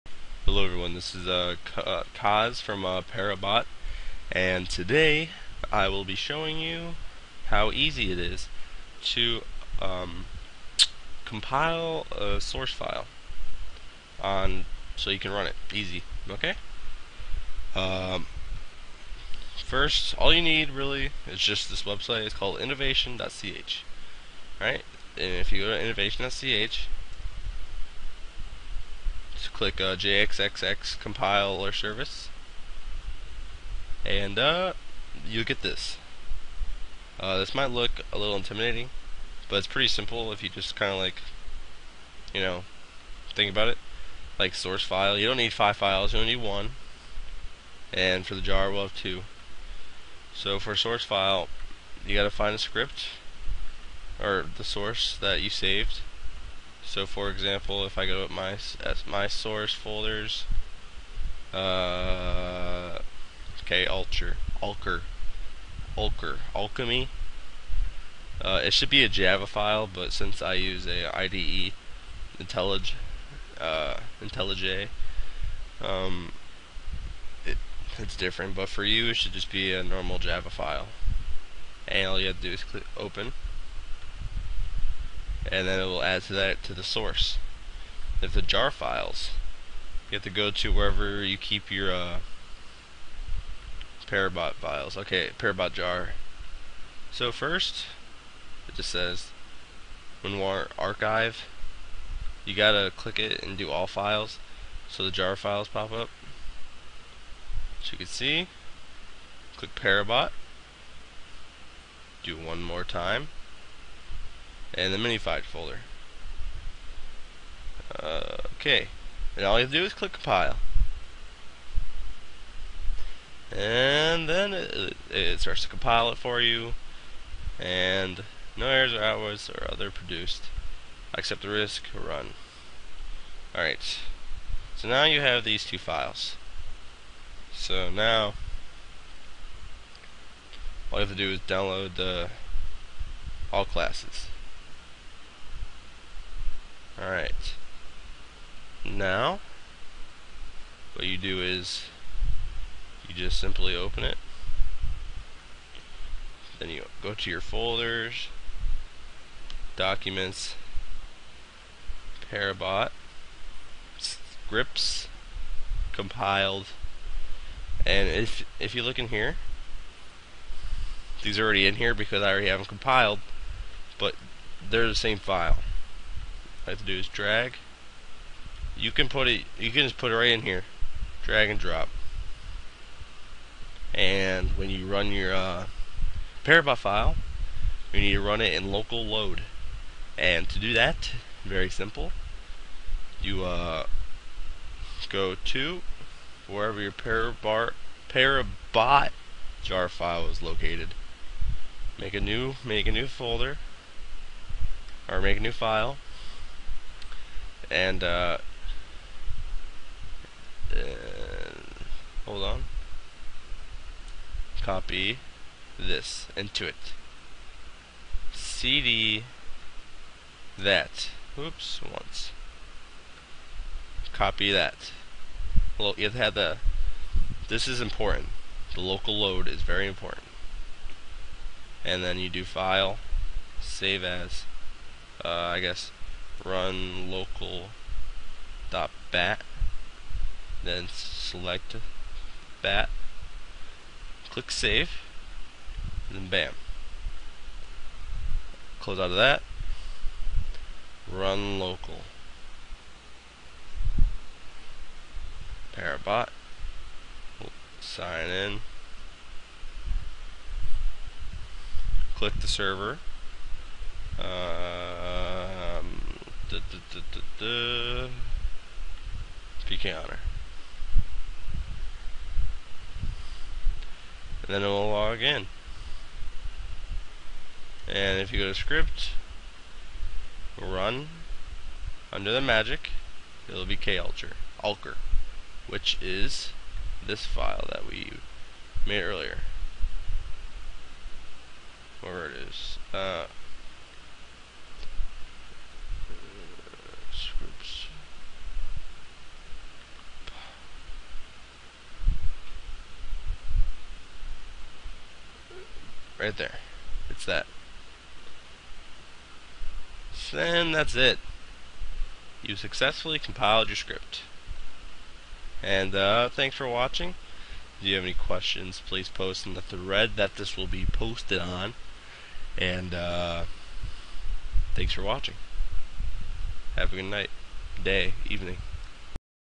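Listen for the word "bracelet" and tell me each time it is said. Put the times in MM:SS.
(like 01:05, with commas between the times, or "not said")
not said.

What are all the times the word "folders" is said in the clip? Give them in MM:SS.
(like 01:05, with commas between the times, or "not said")
00:59, 01:55, 02:37, 03:23.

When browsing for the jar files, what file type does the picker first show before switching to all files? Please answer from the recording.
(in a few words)
WinRAR archive.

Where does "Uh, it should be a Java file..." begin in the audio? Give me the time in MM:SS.
01:08.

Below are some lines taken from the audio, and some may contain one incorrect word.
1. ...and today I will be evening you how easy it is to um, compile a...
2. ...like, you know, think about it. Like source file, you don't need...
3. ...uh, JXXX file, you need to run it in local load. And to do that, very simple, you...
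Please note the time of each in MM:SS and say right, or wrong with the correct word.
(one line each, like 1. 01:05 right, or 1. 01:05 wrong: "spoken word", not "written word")
1. 00:04 wrong: "showing", not "evening"
2. 00:40 right
3. 03:05 wrong: "Parabot", not "JXXX".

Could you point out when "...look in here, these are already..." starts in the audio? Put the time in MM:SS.
02:48.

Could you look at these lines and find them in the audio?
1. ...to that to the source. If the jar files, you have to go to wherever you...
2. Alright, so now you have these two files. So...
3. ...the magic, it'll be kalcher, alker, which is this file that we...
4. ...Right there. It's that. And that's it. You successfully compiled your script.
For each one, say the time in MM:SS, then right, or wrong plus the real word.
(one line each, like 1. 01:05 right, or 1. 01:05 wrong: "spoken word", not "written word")
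1. 01:26 right
2. 02:13 right
3. 04:42 right
4. 05:06 right.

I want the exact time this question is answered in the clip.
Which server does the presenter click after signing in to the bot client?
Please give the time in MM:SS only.
04:29.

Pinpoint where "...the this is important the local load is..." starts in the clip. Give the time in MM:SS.
03:46.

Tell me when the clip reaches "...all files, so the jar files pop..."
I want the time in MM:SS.
01:43.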